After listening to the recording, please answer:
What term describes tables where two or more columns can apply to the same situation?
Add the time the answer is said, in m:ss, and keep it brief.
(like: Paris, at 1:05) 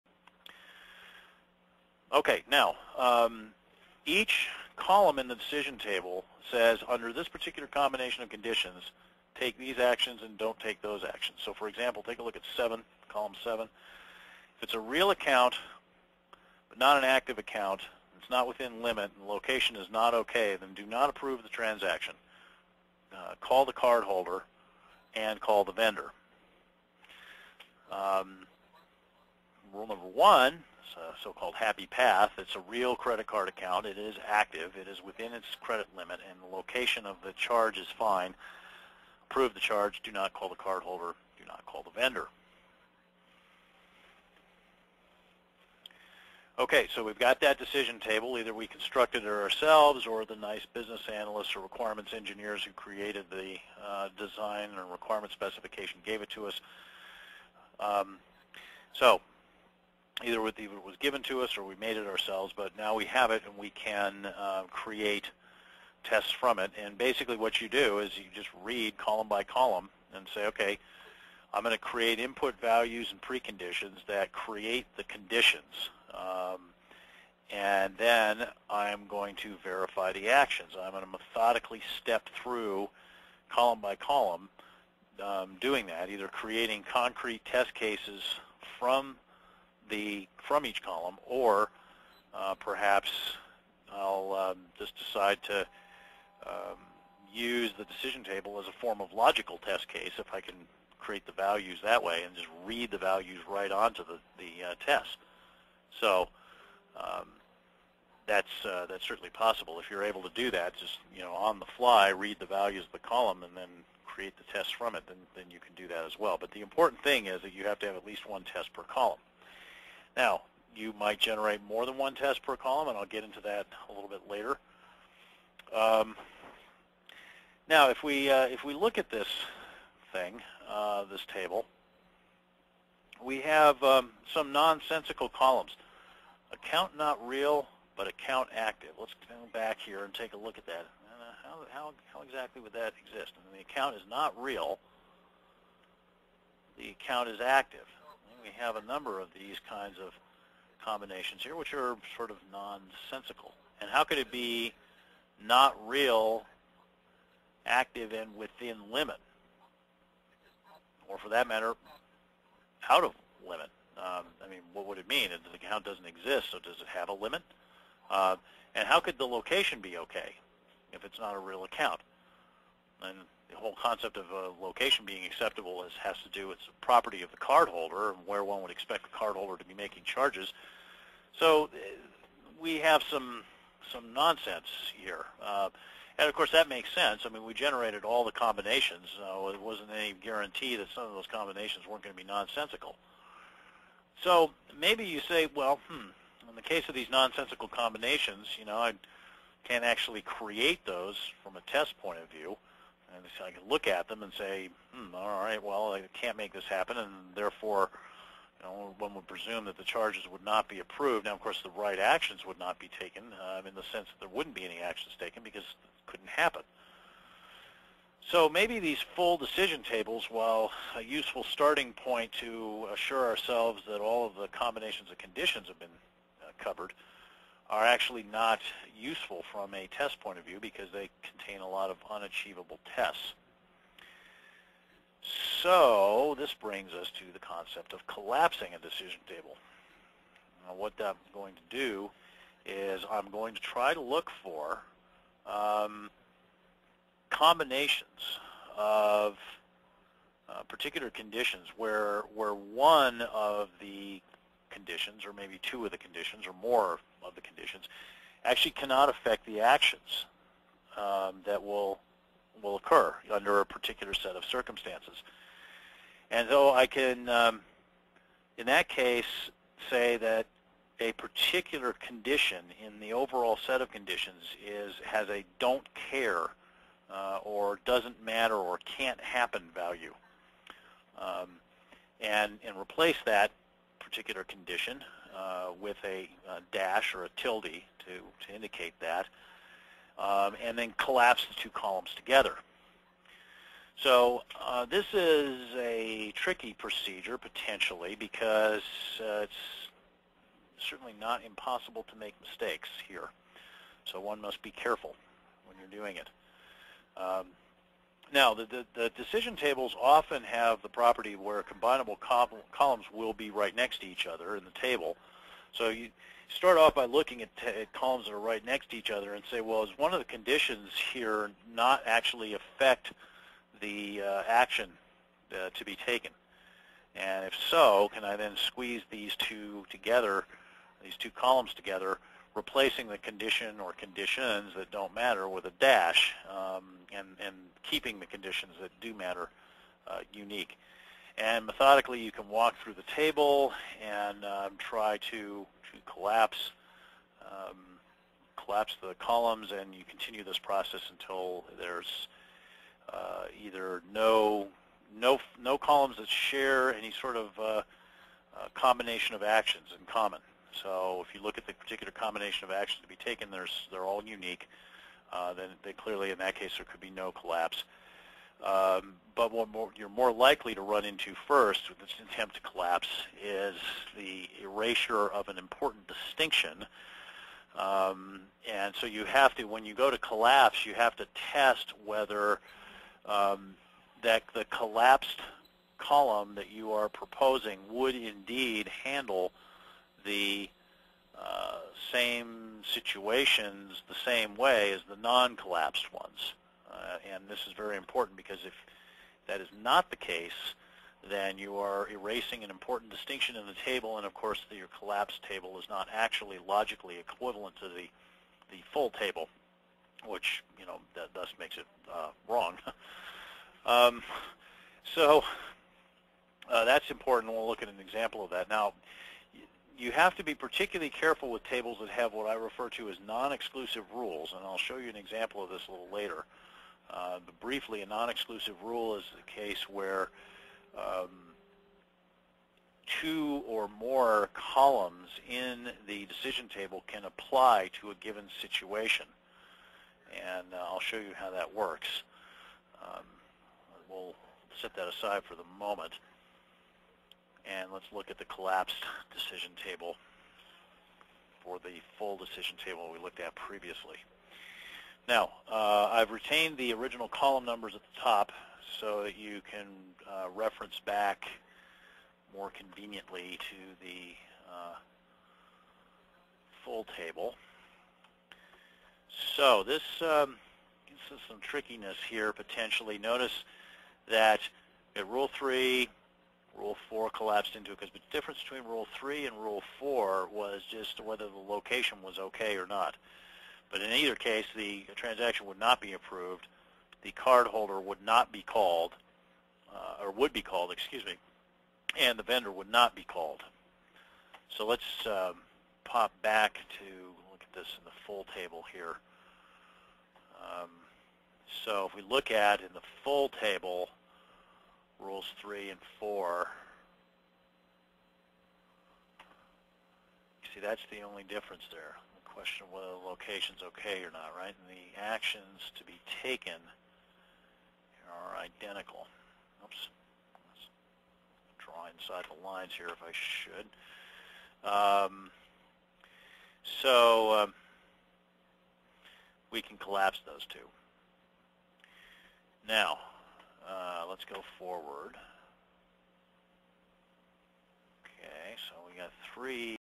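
non-exclusive rules, at 7:03.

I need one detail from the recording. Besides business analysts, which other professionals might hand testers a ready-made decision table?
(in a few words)
requirements engineers.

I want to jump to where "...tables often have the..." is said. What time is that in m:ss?
5:09.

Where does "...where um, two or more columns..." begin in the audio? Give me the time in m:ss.
7:09.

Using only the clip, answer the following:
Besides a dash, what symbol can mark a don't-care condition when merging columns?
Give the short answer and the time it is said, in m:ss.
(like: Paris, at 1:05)
tilde, at 4:47.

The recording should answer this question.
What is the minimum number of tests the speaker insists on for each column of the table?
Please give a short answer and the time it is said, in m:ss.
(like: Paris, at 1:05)
1, at 1:57.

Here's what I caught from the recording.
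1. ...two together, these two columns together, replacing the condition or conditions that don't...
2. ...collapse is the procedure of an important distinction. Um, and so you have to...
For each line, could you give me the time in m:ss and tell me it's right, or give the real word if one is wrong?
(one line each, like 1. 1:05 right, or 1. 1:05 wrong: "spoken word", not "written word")
1. 5:29 right
2. 6:12 wrong: "erasure", not "procedure".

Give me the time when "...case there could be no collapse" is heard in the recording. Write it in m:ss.
6:06.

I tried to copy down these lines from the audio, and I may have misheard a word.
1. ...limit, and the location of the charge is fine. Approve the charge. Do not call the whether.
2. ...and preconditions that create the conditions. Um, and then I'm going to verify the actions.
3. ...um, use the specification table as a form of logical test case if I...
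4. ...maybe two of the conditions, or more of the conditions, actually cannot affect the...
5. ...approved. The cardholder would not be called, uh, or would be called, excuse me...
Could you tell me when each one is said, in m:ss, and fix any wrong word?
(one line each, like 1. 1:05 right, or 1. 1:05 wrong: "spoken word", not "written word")
1. 0:35 wrong: "cardholder", not "whether"
2. 1:13 right
3. 1:36 wrong: "decision", not "specification"
4. 4:15 right
5. 8:06 right.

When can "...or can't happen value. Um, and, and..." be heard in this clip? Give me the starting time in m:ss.
4:38.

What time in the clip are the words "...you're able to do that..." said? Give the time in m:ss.
1:49.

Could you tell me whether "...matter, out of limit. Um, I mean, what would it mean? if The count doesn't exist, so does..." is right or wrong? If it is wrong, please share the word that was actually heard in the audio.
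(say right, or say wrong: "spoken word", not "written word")
right.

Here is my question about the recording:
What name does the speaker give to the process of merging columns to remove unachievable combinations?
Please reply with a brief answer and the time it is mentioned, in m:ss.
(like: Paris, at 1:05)
collapsing a decision table, at 3:58.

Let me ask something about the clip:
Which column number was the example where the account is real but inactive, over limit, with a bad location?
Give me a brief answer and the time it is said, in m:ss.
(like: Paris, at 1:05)
7, at 0:13.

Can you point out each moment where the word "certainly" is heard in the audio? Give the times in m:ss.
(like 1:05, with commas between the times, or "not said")
1:49, 5:00.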